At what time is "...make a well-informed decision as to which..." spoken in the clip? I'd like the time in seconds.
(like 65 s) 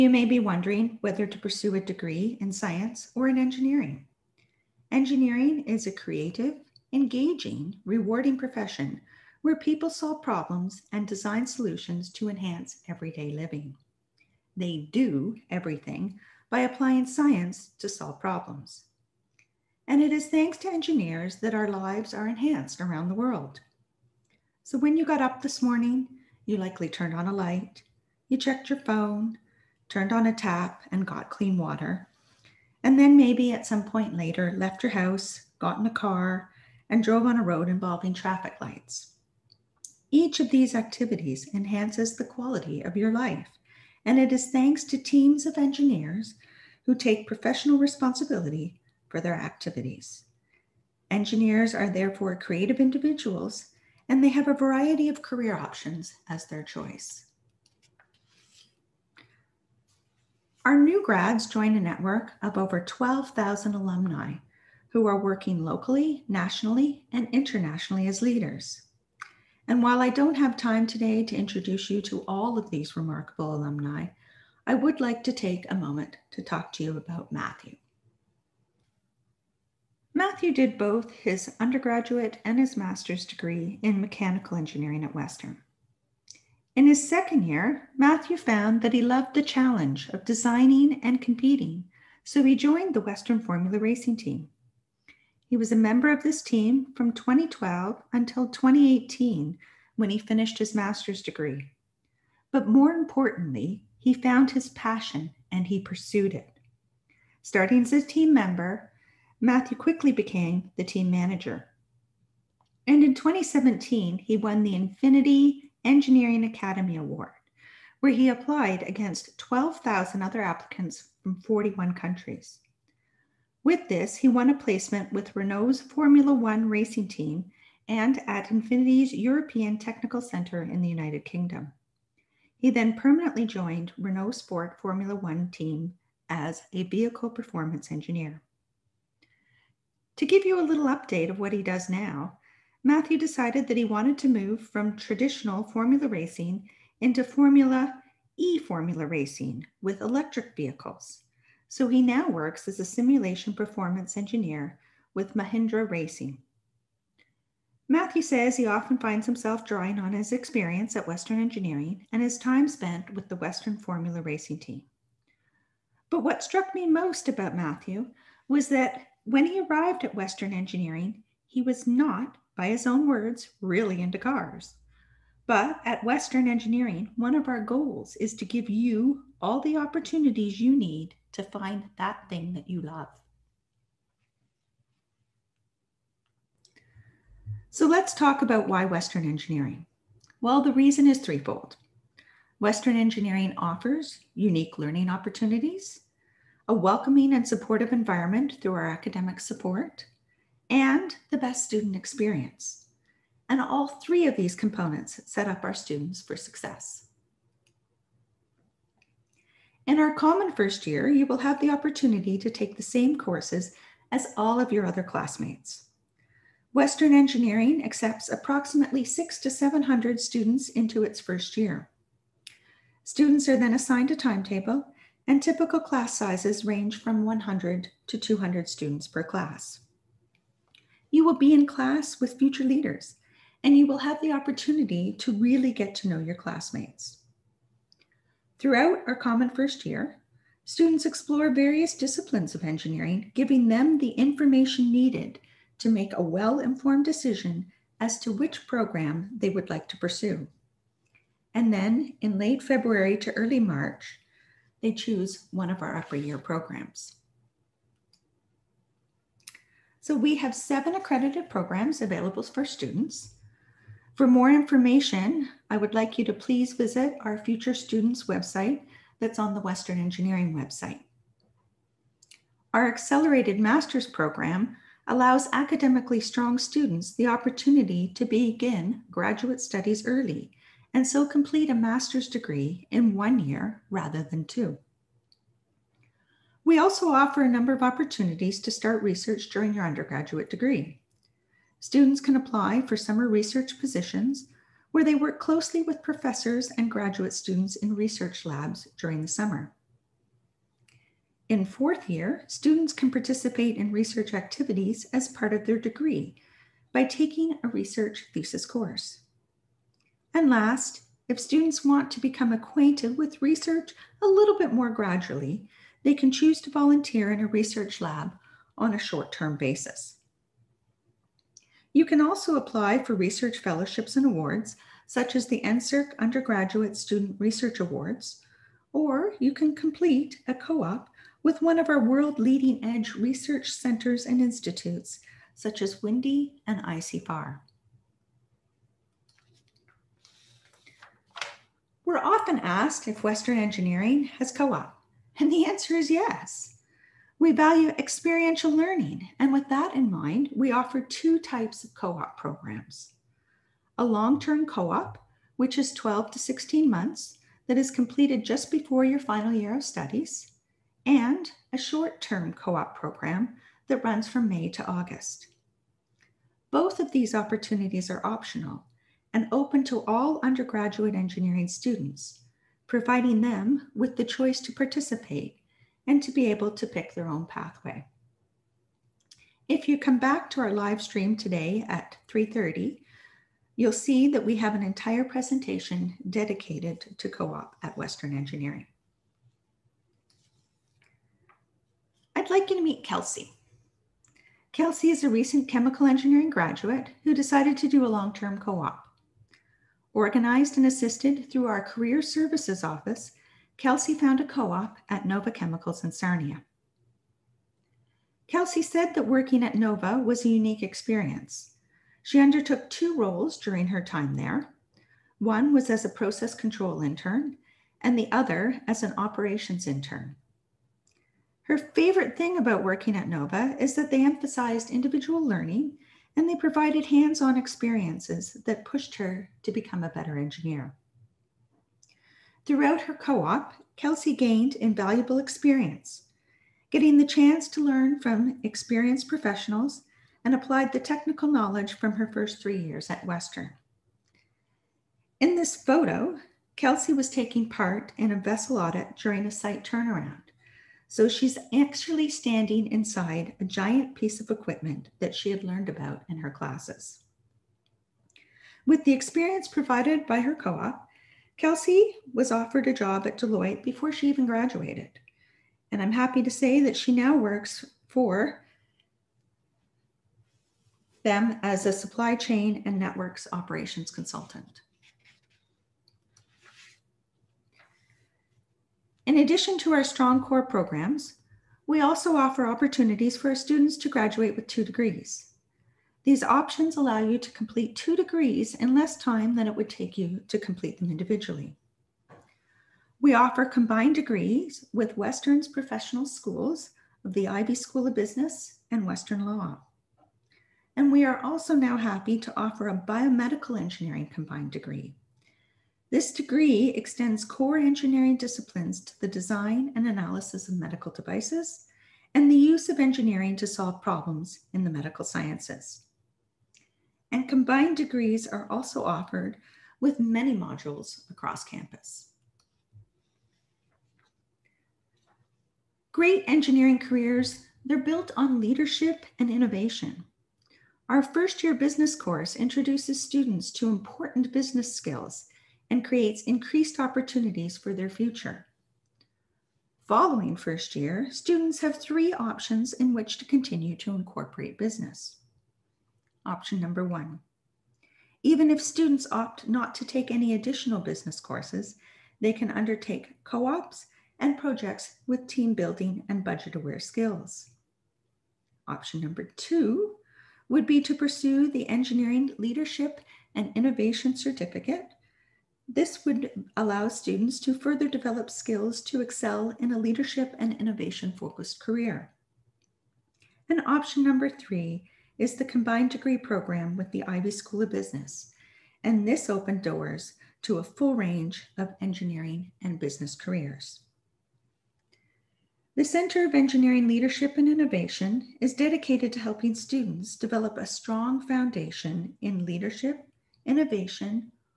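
245 s.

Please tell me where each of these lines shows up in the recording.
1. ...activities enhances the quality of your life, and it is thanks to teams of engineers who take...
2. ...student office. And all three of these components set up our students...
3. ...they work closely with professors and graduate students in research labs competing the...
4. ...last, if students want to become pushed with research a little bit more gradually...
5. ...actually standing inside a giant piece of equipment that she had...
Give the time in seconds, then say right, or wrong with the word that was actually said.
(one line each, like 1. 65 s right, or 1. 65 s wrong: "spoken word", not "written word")
1. 40 s right
2. 201 s wrong: "experience", not "office"
3. 295 s wrong: "during", not "competing"
4. 310 s wrong: "acquainted", not "pushed"
5. 451 s right.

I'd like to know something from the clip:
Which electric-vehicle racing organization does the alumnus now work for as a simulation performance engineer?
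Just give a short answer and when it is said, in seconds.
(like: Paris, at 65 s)
Mahindra Racing, at 155 s.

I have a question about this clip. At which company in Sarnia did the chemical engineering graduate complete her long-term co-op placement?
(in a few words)
Nova Chemicals.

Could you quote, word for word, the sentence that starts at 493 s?
We offer combined degrees with Western's professional schools of the Ivey School of Business and Western Law.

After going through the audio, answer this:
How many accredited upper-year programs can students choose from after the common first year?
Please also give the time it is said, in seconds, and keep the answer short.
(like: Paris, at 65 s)
7, at 260 s.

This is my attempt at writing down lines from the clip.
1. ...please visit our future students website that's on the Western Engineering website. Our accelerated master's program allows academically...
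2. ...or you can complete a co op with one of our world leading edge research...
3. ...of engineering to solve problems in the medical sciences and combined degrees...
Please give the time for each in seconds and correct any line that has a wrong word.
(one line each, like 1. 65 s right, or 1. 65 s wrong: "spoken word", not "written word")
1. 266 s right
2. 328 s right
3. 512 s right.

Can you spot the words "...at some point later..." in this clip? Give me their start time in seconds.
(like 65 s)
33 s.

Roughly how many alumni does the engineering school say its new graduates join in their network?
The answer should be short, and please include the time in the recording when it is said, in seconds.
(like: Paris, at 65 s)
12,000, at 62 s.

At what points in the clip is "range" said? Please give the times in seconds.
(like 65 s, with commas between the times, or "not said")
226 s, 581 s.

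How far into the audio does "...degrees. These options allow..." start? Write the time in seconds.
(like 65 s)
484 s.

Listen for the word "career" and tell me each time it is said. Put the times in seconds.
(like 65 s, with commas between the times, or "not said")
55 s, 401 s, 526 s, 571 s, 583 s.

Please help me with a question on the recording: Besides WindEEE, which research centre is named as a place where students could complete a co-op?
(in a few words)
ICFAR.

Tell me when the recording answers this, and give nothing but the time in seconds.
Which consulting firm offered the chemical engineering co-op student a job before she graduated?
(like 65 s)
463 s.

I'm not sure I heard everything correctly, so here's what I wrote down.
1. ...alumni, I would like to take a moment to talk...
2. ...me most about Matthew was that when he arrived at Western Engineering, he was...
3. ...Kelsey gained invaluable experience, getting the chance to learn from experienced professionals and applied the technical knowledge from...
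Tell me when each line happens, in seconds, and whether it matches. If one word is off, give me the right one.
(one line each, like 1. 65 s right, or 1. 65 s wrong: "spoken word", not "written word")
1. 73 s right
2. 166 s right
3. 433 s right.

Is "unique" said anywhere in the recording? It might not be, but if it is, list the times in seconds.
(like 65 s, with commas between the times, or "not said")
194 s, 410 s.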